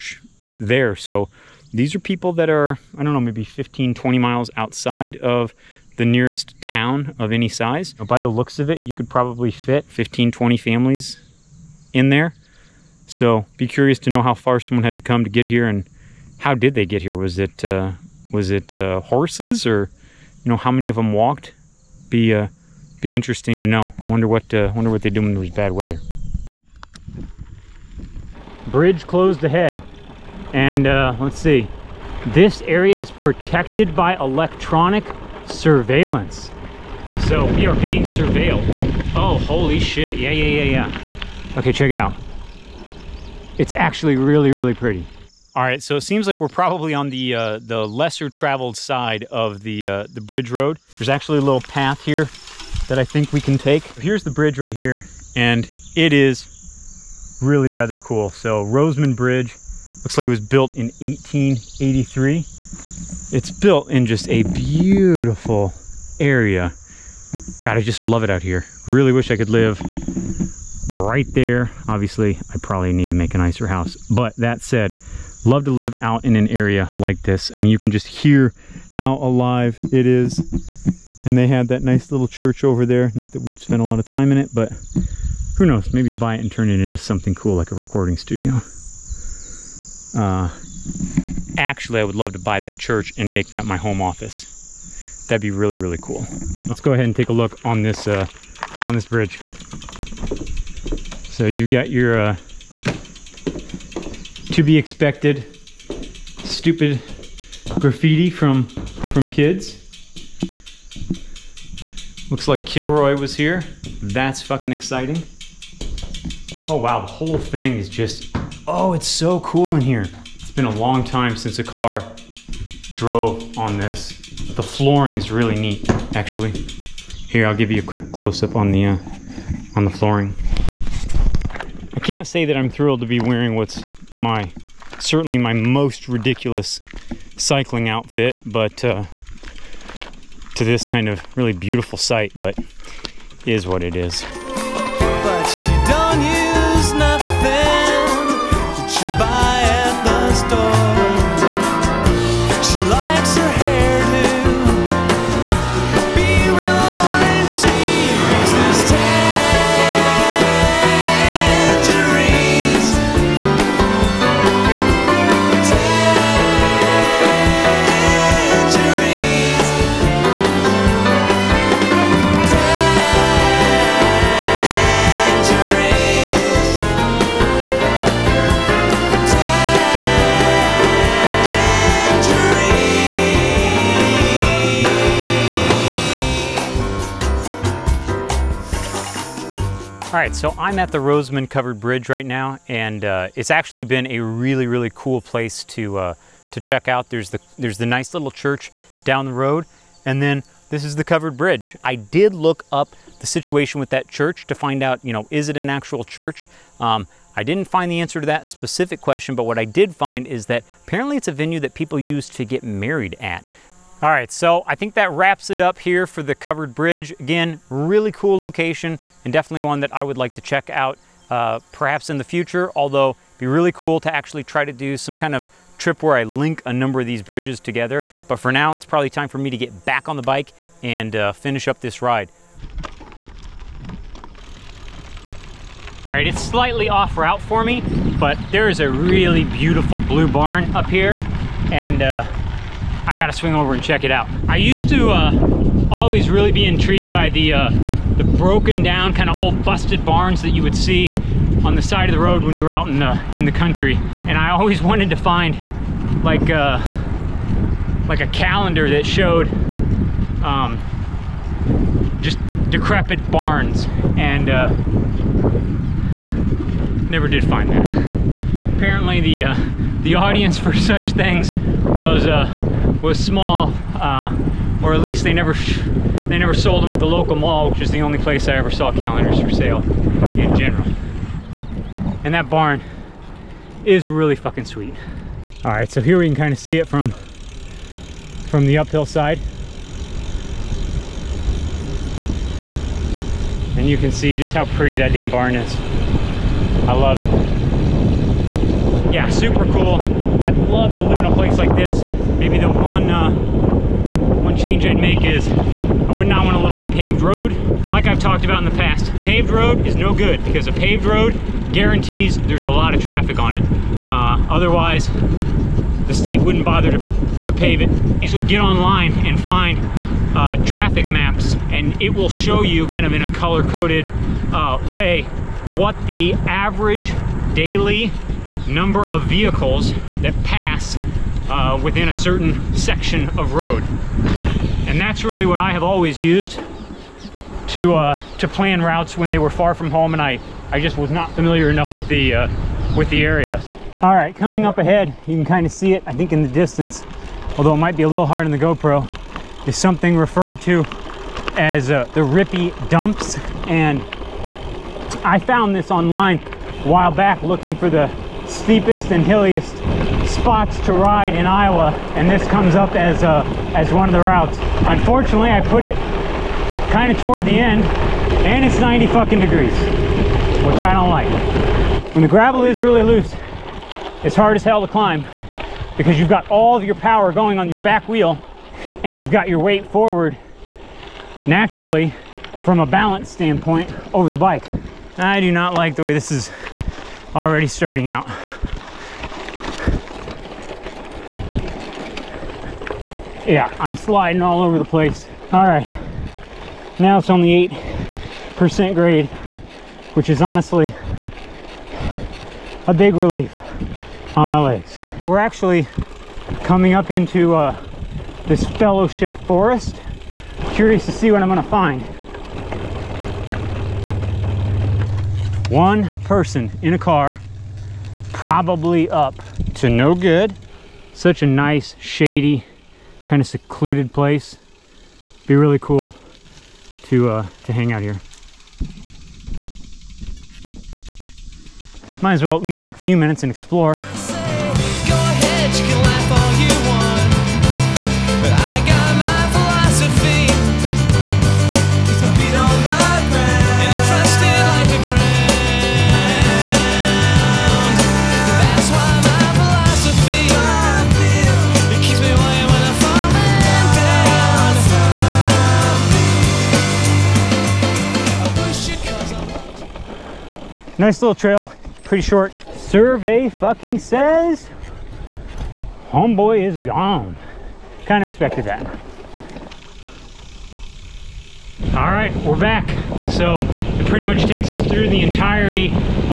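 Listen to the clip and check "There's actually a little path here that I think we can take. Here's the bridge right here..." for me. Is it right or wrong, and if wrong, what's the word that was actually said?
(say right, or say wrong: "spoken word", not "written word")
right.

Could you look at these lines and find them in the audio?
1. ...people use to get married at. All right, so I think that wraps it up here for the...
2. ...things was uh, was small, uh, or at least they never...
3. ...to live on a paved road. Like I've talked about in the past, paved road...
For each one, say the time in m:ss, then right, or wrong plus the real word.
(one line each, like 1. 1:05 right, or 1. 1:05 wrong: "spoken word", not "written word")
1. 3:31 right
2. 4:31 right
3. 5:06 right.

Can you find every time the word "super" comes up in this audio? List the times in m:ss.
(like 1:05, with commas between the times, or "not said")
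4:59.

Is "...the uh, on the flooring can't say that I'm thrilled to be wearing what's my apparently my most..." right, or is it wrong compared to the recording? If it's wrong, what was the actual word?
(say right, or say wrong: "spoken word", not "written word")
wrong: "certainly", not "apparently".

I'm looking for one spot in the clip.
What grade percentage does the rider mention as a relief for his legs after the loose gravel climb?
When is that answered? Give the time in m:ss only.
6:37.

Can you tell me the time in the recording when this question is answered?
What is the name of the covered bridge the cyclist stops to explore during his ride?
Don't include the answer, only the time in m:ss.
0:58.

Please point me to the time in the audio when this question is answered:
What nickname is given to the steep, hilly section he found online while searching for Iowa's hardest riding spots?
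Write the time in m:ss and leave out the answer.
5:52.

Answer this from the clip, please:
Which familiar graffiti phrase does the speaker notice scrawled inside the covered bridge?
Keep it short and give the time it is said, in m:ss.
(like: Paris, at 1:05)
Kilroy was here, at 1:52.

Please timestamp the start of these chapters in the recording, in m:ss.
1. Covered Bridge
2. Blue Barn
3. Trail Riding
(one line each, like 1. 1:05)
1. 0:29
2. 3:56
3. 6:53.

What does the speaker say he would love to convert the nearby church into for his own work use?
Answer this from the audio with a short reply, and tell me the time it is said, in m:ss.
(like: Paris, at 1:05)
home office, at 1:33.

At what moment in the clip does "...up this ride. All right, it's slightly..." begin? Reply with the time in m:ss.
3:51.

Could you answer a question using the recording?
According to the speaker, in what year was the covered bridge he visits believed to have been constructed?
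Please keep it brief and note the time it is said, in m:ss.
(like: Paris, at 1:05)
1883, at 1:01.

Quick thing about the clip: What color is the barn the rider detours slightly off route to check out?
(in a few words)
blue.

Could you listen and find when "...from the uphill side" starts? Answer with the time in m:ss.
4:47.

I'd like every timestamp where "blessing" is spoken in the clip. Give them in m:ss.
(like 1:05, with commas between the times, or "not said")
not said.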